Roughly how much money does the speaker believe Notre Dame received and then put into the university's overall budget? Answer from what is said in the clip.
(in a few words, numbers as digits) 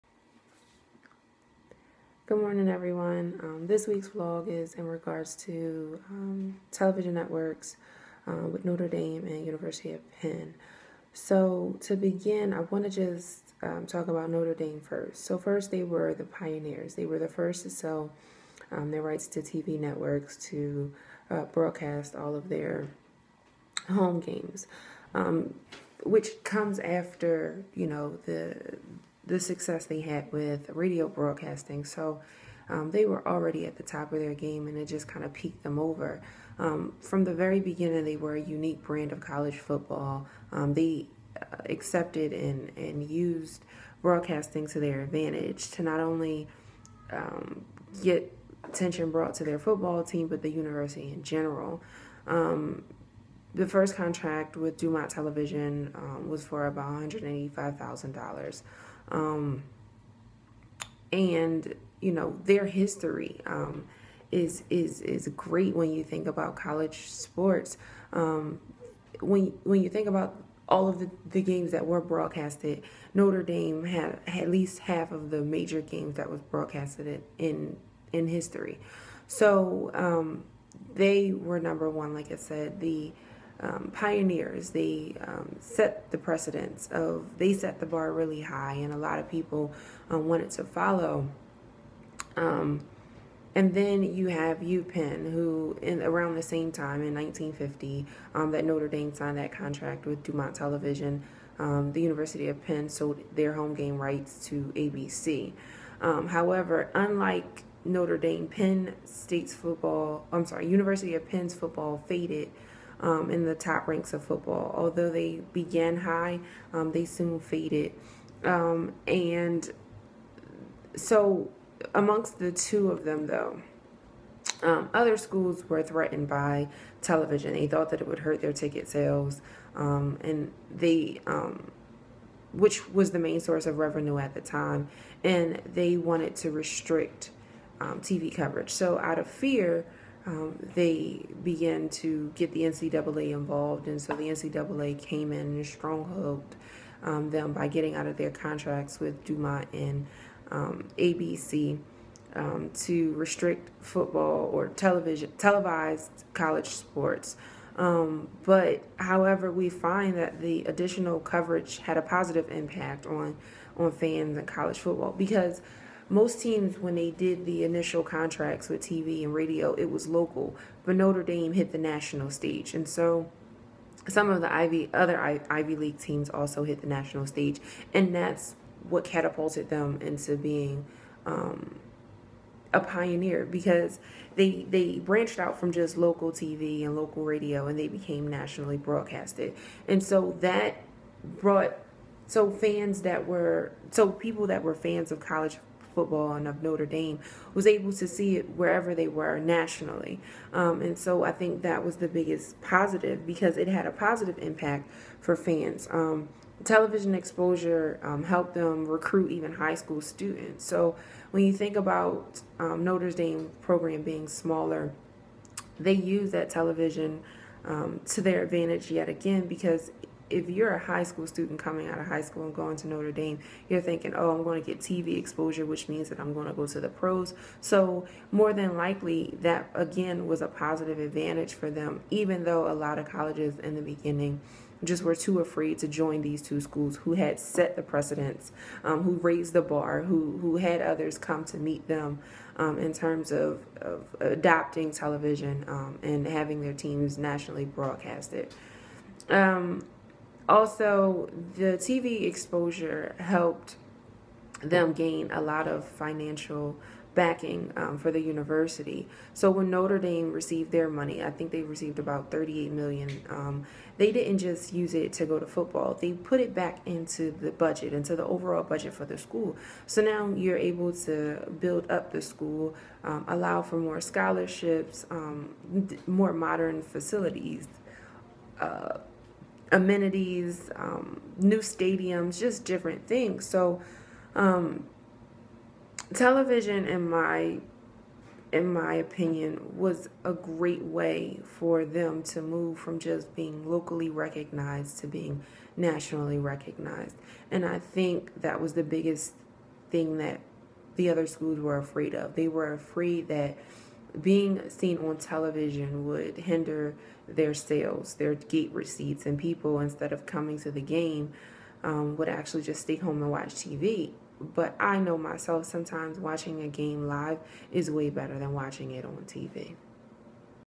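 38 million.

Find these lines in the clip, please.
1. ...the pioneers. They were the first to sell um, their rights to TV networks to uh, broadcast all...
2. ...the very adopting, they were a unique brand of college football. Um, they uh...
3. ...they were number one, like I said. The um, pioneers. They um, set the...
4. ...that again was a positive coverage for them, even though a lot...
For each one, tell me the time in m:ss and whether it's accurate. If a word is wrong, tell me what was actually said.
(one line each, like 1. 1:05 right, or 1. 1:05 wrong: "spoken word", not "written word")
1. 0:16 right
2. 0:37 wrong: "beginning", not "adopting"
3. 1:20 right
4. 3:49 wrong: "advantage", not "coverage".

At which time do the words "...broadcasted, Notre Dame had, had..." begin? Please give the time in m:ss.
1:11.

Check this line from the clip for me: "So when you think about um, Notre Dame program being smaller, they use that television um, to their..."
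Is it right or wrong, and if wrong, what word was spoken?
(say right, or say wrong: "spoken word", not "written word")
right.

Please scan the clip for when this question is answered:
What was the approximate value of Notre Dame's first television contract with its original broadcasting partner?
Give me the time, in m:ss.
0:57.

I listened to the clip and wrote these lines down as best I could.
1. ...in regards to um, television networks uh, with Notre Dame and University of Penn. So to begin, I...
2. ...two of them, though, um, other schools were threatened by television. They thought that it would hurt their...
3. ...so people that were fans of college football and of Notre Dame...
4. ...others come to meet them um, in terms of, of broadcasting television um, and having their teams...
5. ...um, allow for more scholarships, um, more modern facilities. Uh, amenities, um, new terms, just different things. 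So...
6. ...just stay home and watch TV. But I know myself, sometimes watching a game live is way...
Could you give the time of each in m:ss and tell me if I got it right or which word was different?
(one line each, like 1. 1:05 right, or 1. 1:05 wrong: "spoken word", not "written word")
1. 0:04 right
2. 2:02 right
3. 3:13 right
4. 4:00 wrong: "adopting", not "broadcasting"
5. 4:33 wrong: "stadiums", not "terms"
6. 5:12 right.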